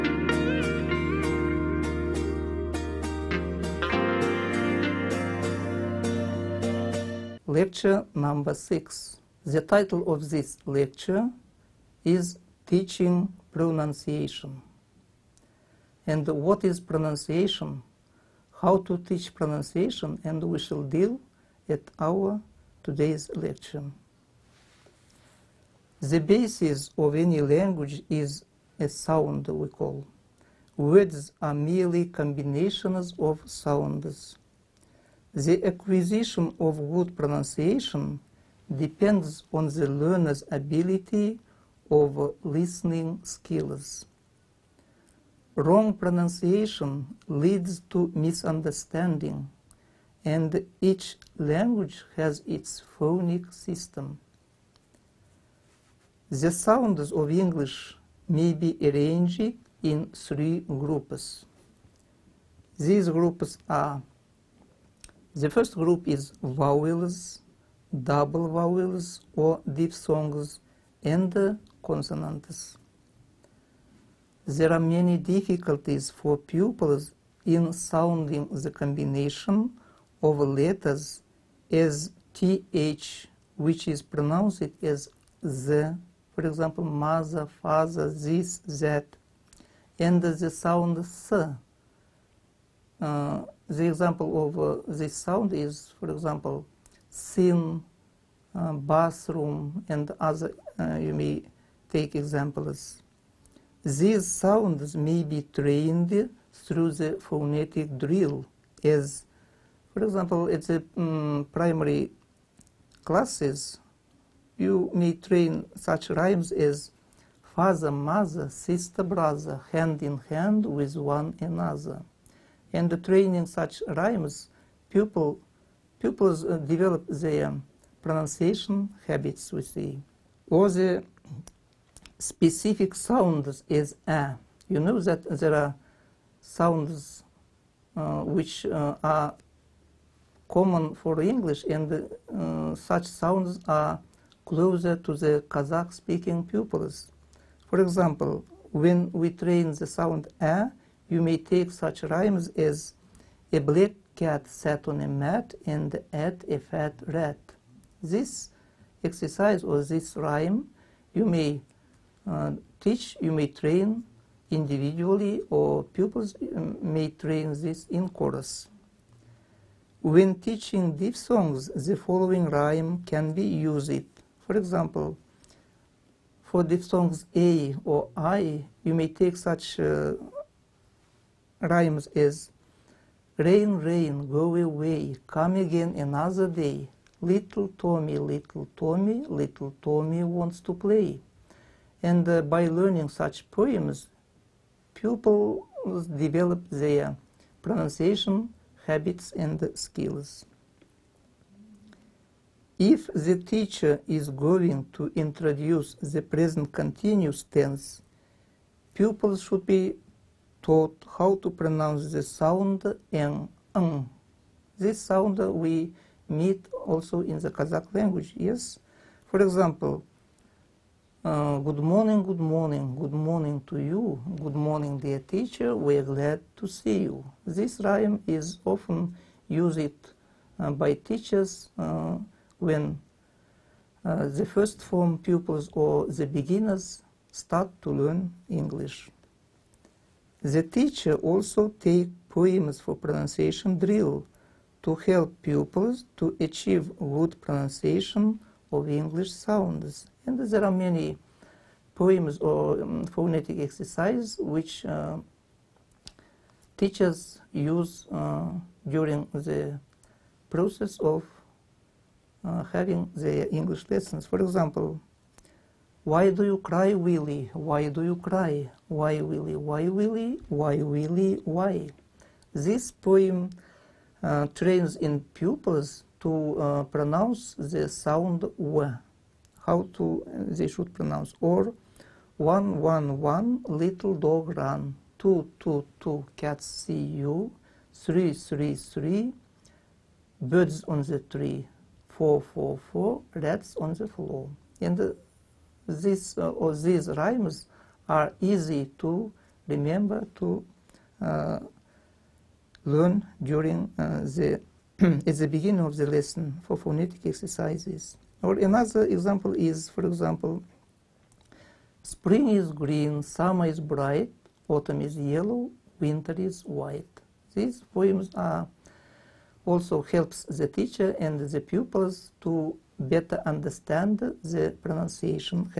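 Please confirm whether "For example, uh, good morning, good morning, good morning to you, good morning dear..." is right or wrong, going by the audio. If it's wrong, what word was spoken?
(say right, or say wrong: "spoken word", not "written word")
right.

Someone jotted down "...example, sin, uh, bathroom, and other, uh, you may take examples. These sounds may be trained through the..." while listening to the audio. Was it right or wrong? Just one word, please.
right.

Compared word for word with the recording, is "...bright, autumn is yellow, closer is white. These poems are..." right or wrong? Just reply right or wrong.
wrong.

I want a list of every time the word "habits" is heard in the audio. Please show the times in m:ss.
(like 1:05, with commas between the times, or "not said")
2:09, 3:18.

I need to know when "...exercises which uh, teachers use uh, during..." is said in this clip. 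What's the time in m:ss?
4:13.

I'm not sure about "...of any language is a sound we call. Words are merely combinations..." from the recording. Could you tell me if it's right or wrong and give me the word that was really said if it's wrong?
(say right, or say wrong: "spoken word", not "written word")
right.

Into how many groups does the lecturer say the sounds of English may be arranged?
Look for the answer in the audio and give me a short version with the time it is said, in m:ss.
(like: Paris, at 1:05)
3, at 1:00.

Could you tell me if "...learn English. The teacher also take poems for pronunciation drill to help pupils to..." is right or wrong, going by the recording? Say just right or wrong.
right.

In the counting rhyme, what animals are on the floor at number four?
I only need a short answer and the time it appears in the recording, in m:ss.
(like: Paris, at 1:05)
rats, at 4:53.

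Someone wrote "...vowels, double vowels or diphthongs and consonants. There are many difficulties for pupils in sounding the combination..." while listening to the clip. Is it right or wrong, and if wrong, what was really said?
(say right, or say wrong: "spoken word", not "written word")
right.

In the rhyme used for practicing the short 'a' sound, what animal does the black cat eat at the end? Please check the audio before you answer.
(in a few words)
a fat rat.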